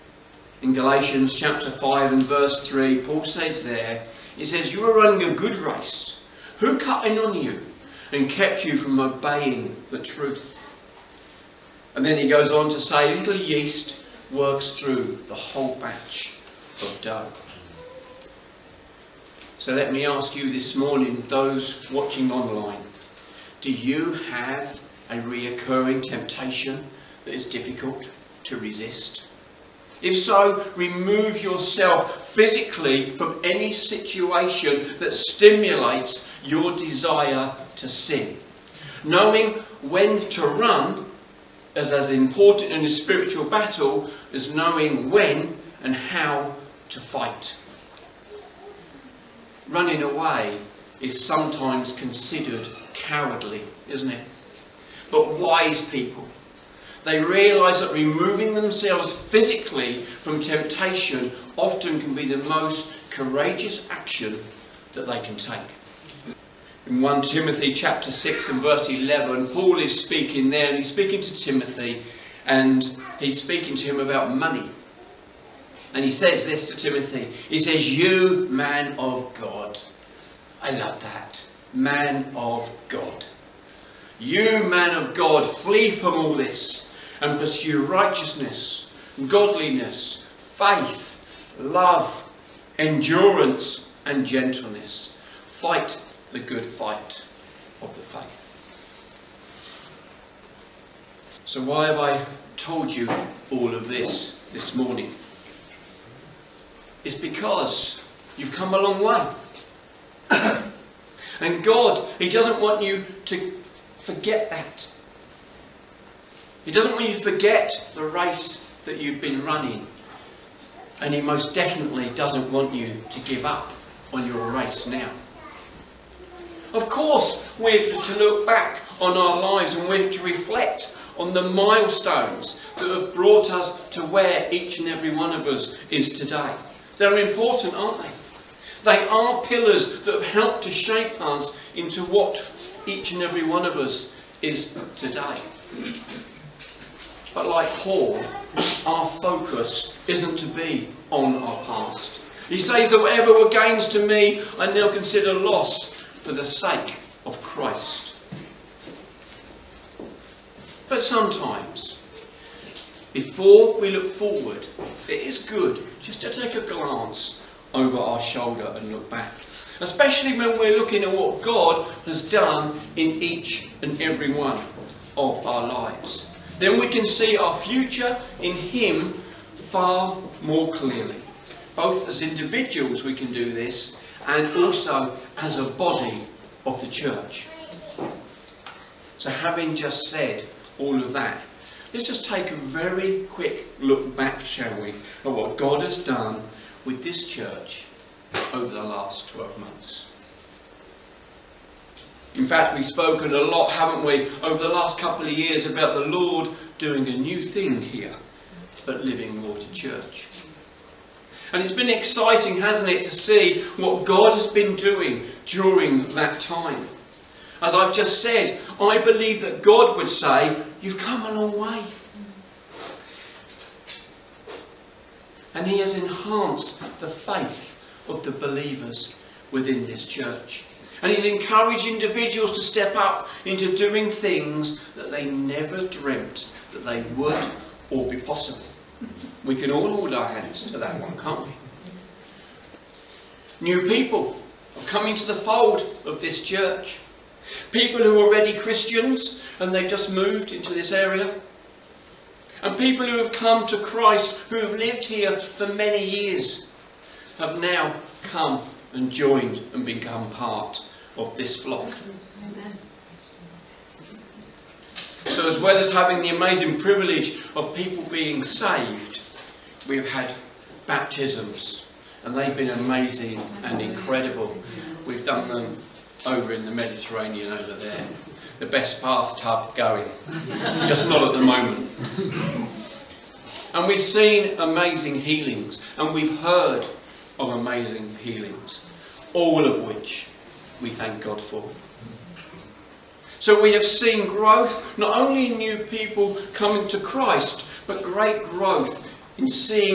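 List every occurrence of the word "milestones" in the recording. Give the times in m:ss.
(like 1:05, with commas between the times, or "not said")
2:11.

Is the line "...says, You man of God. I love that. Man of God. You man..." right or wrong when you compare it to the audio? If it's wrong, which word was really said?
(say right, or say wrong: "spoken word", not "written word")
right.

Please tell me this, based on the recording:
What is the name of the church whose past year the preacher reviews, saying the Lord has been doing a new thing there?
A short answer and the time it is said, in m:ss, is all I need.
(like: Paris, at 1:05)
Living Water Church, at 3:29.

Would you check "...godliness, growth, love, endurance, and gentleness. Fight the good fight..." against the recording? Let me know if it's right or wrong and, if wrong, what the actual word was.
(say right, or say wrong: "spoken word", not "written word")
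wrong: "faith", not "growth".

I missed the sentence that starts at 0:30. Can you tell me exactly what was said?
If so, remove yourself physically from any situation that stimulates your desire to sin.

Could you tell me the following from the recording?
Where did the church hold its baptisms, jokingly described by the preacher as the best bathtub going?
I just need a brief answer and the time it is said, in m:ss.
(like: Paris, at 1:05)
The Mediterranean, at 4:36.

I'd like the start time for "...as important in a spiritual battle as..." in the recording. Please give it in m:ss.
0:41.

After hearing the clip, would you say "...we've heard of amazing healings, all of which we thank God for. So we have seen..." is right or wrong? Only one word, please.
right.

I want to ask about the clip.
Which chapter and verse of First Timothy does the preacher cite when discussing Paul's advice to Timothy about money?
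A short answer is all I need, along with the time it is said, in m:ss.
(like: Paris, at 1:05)
Chapter 6, verse 11, at 1:07.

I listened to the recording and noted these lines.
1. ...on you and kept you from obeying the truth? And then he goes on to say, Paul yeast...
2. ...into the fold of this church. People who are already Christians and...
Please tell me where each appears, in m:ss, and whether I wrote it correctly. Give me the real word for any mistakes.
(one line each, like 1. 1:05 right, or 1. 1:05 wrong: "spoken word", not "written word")
1. 0:07 wrong: "Little", not "Paul"
2. 4:05 right.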